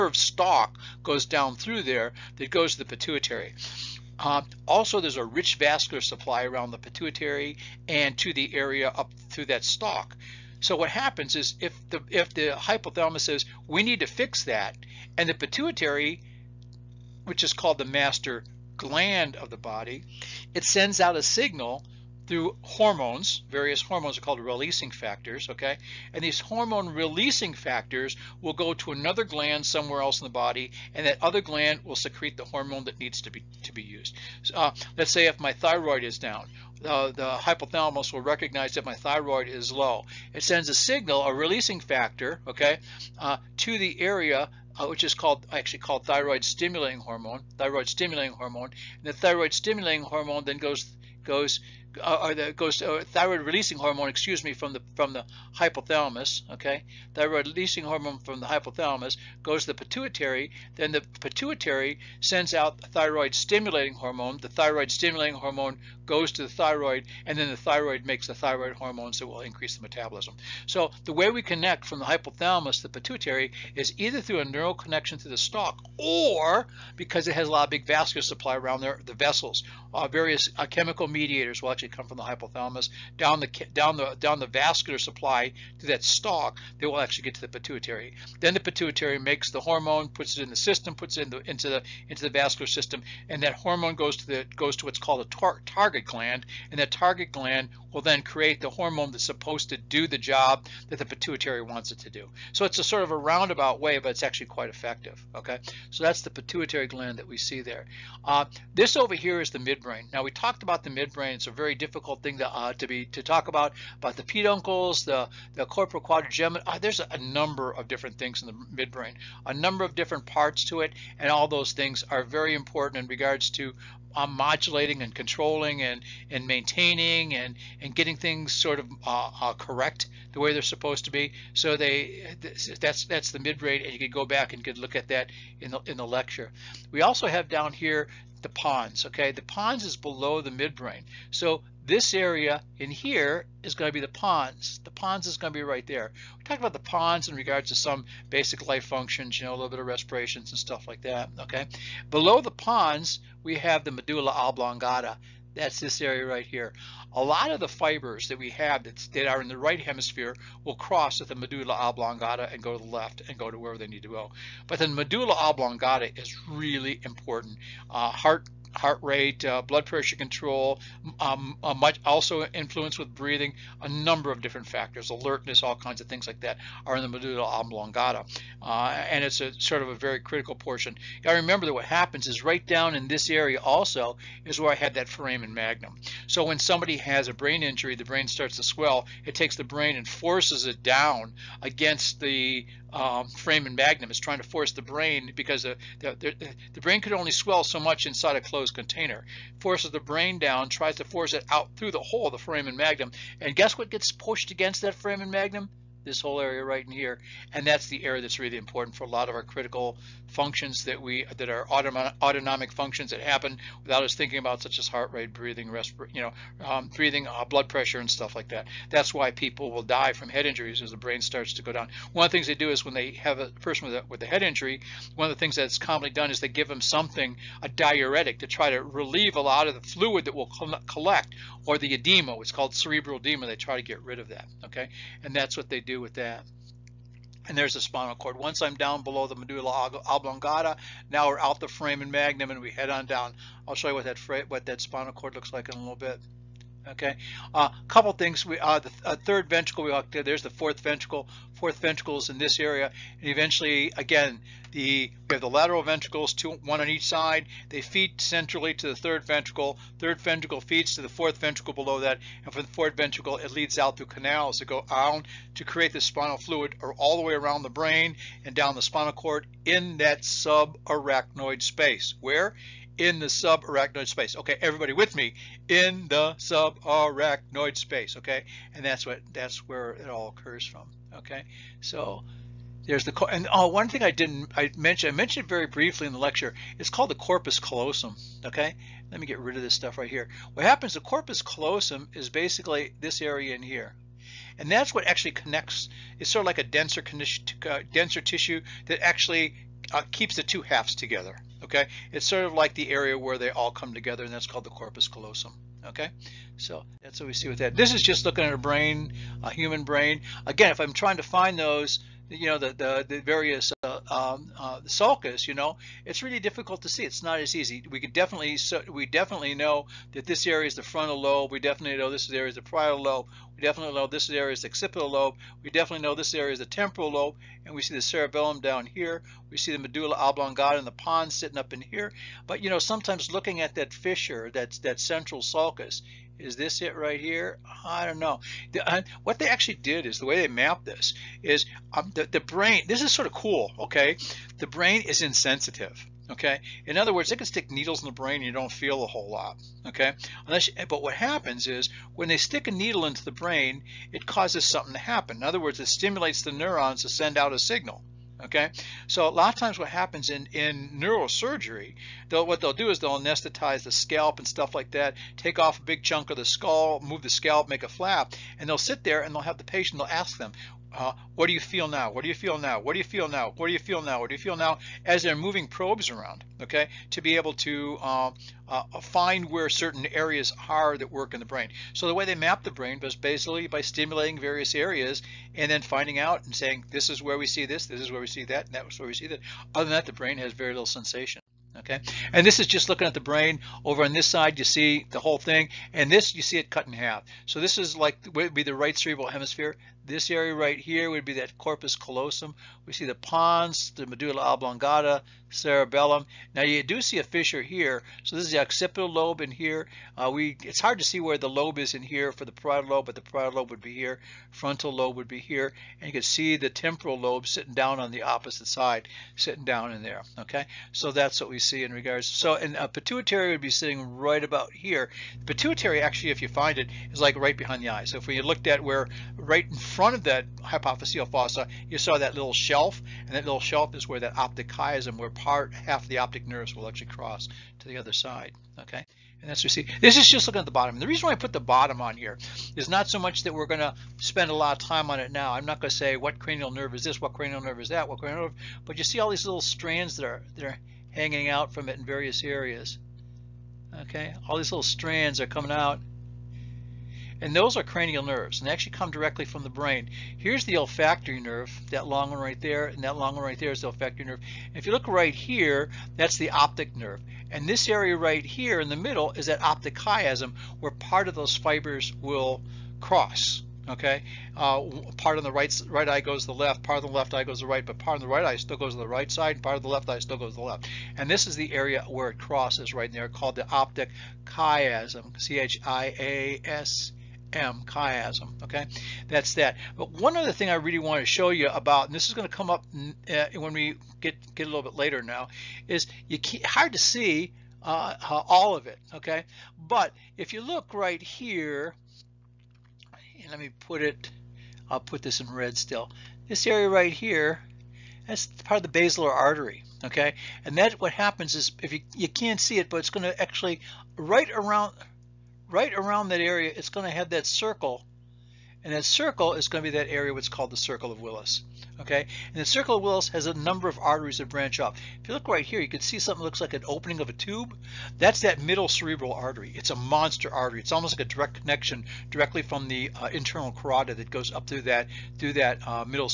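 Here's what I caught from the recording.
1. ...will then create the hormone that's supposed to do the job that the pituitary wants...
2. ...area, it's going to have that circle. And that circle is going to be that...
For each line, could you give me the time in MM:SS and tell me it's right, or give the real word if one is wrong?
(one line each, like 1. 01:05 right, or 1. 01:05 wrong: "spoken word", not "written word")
1. 01:37 right
2. 08:36 right.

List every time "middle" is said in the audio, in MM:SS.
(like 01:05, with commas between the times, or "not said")
07:48, 08:48.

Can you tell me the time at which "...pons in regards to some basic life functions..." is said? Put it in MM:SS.
02:26.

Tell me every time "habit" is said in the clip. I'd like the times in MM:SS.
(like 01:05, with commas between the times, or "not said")
not said.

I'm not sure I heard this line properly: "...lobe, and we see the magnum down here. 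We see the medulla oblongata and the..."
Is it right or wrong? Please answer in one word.
wrong.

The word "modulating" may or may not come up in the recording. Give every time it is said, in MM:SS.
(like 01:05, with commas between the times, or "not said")
02:04.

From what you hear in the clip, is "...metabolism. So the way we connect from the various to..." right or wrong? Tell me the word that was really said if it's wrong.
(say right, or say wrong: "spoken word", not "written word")
wrong: "hypothalamus", not "various".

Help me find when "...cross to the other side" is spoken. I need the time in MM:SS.
07:17.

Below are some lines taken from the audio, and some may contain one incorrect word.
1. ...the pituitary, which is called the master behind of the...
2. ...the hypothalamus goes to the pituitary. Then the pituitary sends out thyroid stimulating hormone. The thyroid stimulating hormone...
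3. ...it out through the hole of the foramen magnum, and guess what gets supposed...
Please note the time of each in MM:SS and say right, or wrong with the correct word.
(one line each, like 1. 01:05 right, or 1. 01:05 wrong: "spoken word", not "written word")
1. 00:15 wrong: "gland", not "behind"
2. 00:58 right
3. 03:21 wrong: "pushed", not "supposed".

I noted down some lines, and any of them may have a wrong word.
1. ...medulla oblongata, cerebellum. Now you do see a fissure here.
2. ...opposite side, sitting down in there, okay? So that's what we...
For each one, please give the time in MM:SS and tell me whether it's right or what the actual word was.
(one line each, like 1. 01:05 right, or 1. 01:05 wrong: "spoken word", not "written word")
1. 06:44 right
2. 06:58 right.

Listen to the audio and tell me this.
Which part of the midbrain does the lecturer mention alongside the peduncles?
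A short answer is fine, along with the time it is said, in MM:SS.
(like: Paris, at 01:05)
corpora quadrigemina, at 01:55.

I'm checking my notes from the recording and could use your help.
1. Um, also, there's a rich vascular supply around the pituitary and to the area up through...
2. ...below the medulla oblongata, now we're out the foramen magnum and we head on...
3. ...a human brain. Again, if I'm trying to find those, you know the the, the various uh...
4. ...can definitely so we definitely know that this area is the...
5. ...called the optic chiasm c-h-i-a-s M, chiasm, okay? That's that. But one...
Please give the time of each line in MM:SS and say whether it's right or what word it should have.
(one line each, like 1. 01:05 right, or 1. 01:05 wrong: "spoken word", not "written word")
1. 00:04 right
2. 03:59 right
3. 05:09 right
4. 05:17 right
5. 08:03 right.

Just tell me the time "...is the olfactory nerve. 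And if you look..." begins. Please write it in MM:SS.
07:43.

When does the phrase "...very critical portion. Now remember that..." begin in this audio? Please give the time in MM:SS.
02:59.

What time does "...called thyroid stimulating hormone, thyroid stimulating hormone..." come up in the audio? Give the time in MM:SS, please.
00:45.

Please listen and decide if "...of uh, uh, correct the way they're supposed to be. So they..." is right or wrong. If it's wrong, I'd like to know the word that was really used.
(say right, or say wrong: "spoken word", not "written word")
right.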